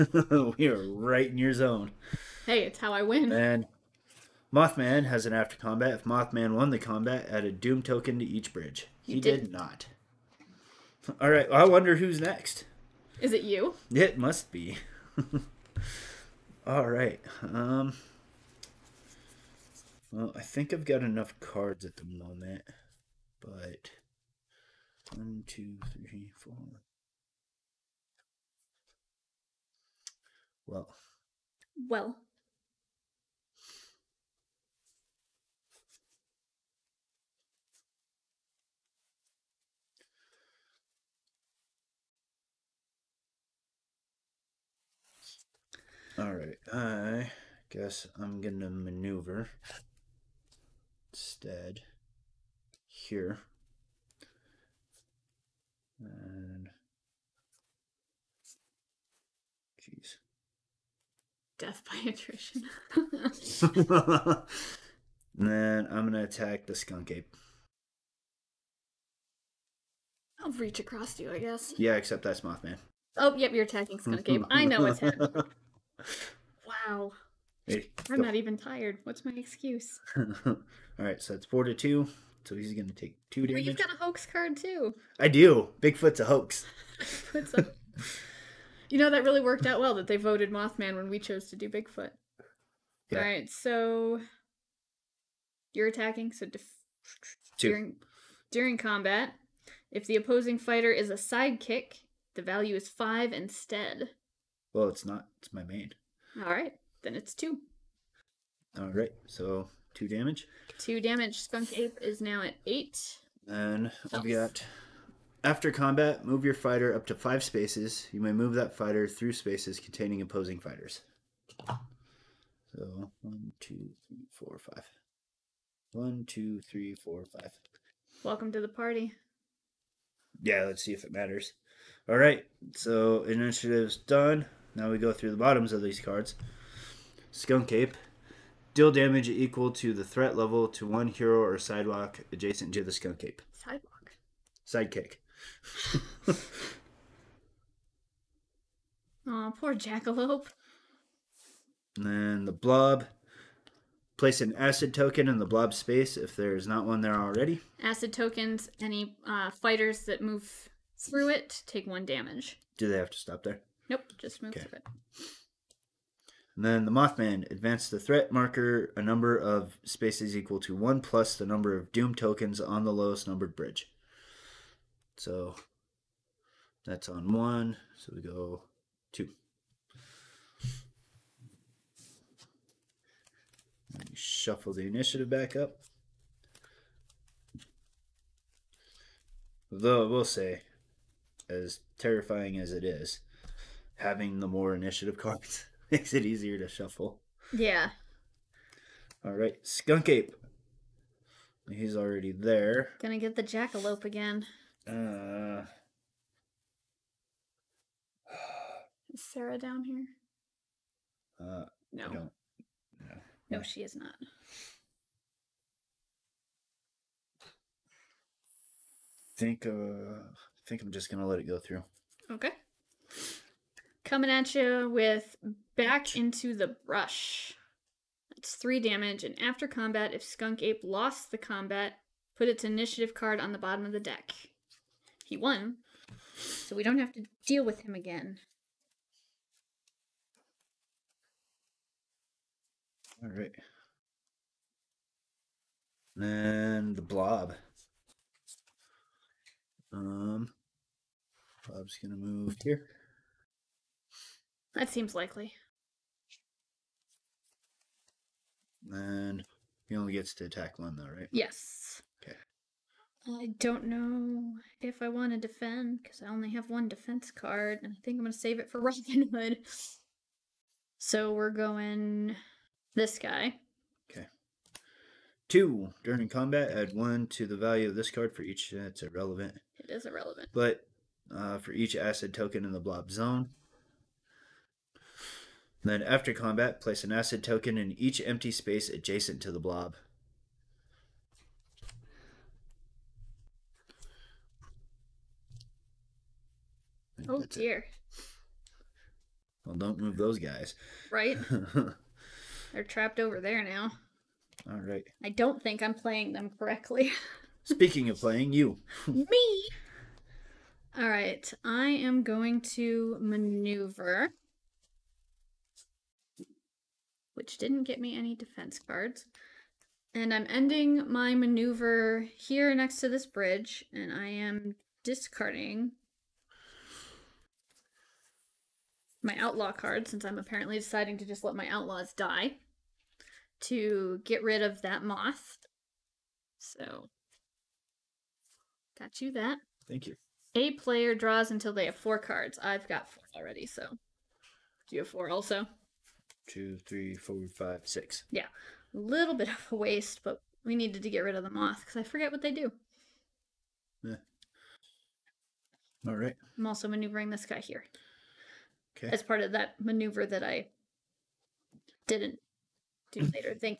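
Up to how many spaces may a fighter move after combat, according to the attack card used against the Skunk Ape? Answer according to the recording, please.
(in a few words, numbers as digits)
5.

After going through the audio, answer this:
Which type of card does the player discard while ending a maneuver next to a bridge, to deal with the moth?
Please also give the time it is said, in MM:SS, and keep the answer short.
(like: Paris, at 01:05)
Outlaw card, at 05:29.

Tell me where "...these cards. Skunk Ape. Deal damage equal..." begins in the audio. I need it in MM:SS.
02:15.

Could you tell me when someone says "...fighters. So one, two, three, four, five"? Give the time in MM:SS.
02:00.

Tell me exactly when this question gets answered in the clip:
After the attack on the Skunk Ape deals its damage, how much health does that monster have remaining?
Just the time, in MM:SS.
01:51.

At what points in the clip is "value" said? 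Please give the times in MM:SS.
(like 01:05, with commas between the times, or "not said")
01:42, 04:37.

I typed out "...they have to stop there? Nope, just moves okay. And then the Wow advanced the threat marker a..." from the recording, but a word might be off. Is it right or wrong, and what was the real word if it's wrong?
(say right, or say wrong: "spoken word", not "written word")
wrong: "Mothman", not "Wow".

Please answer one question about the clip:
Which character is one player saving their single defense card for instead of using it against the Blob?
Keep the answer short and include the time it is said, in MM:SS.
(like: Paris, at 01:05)
Robin Hood, at 04:28.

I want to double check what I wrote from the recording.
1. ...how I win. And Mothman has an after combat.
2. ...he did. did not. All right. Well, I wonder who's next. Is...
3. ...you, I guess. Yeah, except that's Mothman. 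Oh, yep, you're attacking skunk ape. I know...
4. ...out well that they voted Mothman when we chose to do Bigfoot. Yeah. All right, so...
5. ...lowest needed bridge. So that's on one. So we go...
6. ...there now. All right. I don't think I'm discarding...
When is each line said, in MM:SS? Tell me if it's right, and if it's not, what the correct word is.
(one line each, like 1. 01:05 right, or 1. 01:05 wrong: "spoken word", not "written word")
1. 00:02 right
2. 00:09 right
3. 01:11 right
4. 01:29 right
5. 02:52 wrong: "numbered", not "needed"
6. 05:03 wrong: "playing", not "discarding".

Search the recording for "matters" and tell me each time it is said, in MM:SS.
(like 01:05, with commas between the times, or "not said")
02:11.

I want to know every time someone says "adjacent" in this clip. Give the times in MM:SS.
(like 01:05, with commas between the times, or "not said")
02:22, 04:48.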